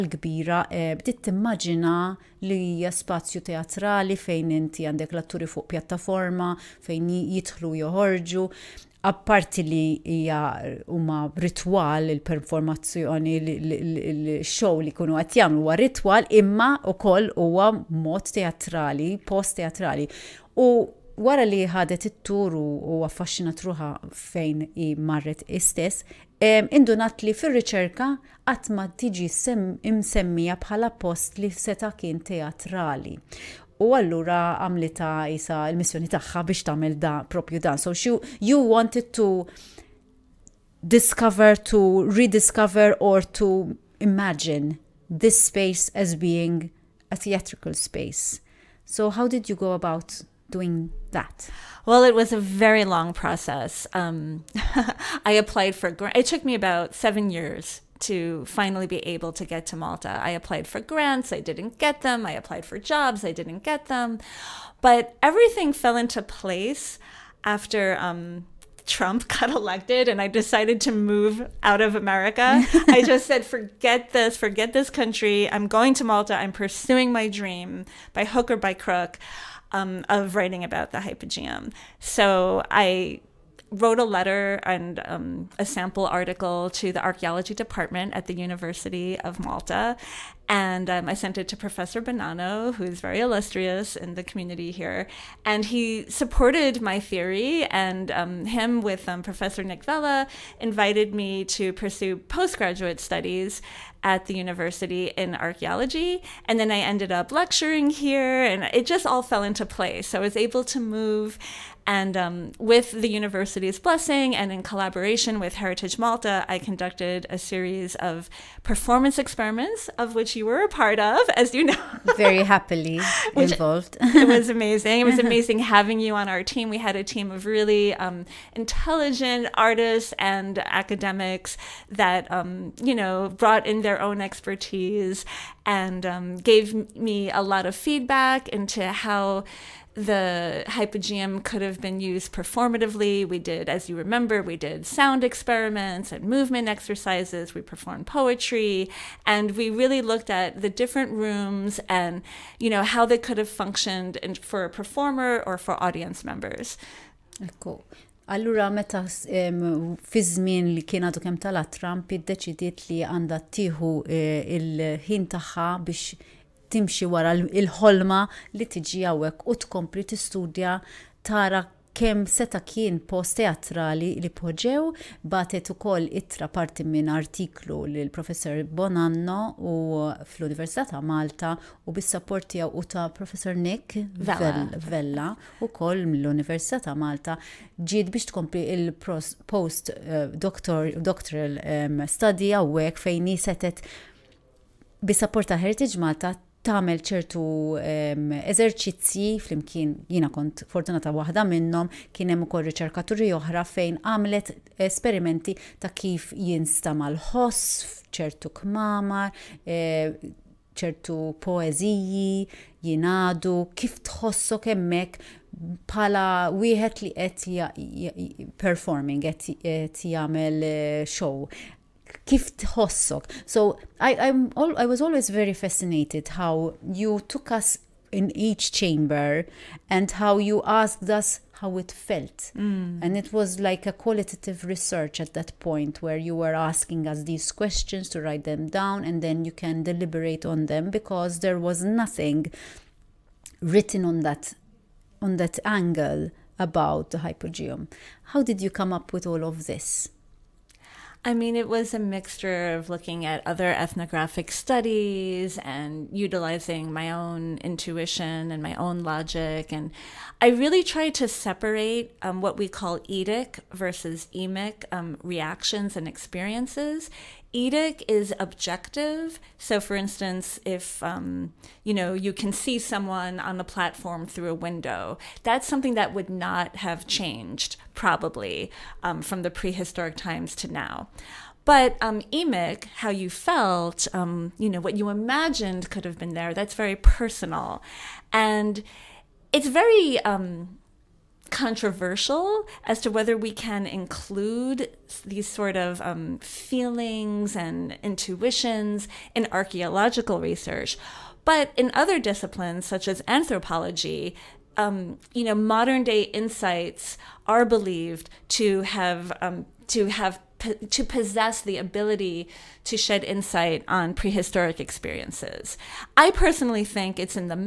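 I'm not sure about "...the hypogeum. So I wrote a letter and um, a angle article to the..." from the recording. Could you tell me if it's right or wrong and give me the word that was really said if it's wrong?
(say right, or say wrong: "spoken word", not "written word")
wrong: "sample", not "angle".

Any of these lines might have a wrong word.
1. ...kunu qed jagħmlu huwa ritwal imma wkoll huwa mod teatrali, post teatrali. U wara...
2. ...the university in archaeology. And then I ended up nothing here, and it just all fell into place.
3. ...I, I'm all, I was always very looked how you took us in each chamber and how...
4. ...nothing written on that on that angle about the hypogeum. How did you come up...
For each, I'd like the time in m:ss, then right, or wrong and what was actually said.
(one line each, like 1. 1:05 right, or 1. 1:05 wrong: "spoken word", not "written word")
1. 0:14 right
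2. 1:44 wrong: "lecturing", not "nothing"
3. 3:43 wrong: "fascinated", not "looked"
4. 4:01 right.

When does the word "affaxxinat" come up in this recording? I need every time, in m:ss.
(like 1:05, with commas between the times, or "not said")
0:23.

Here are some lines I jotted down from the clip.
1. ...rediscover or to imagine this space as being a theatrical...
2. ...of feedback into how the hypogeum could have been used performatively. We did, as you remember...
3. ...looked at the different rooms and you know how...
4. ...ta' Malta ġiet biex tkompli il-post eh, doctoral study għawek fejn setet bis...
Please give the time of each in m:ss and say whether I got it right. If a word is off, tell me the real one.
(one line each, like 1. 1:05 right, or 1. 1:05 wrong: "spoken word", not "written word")
1. 0:42 right
2. 2:17 right
3. 2:30 right
4. 3:06 right.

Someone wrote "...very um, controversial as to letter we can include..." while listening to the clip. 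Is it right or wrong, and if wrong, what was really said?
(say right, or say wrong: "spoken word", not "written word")
wrong: "whether", not "letter".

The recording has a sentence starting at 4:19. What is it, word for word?
And I really tried to separate um, what we call etic versus emic um, reactions and experiences etic is objective.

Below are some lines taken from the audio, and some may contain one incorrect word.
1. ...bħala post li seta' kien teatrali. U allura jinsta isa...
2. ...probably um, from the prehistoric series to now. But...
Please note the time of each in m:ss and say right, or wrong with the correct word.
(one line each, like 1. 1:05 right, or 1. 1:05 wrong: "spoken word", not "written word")
1. 0:30 wrong: "għamlita", not "jinsta"
2. 4:37 wrong: "times", not "series".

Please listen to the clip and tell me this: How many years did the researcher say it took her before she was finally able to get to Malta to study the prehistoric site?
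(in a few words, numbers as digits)
7.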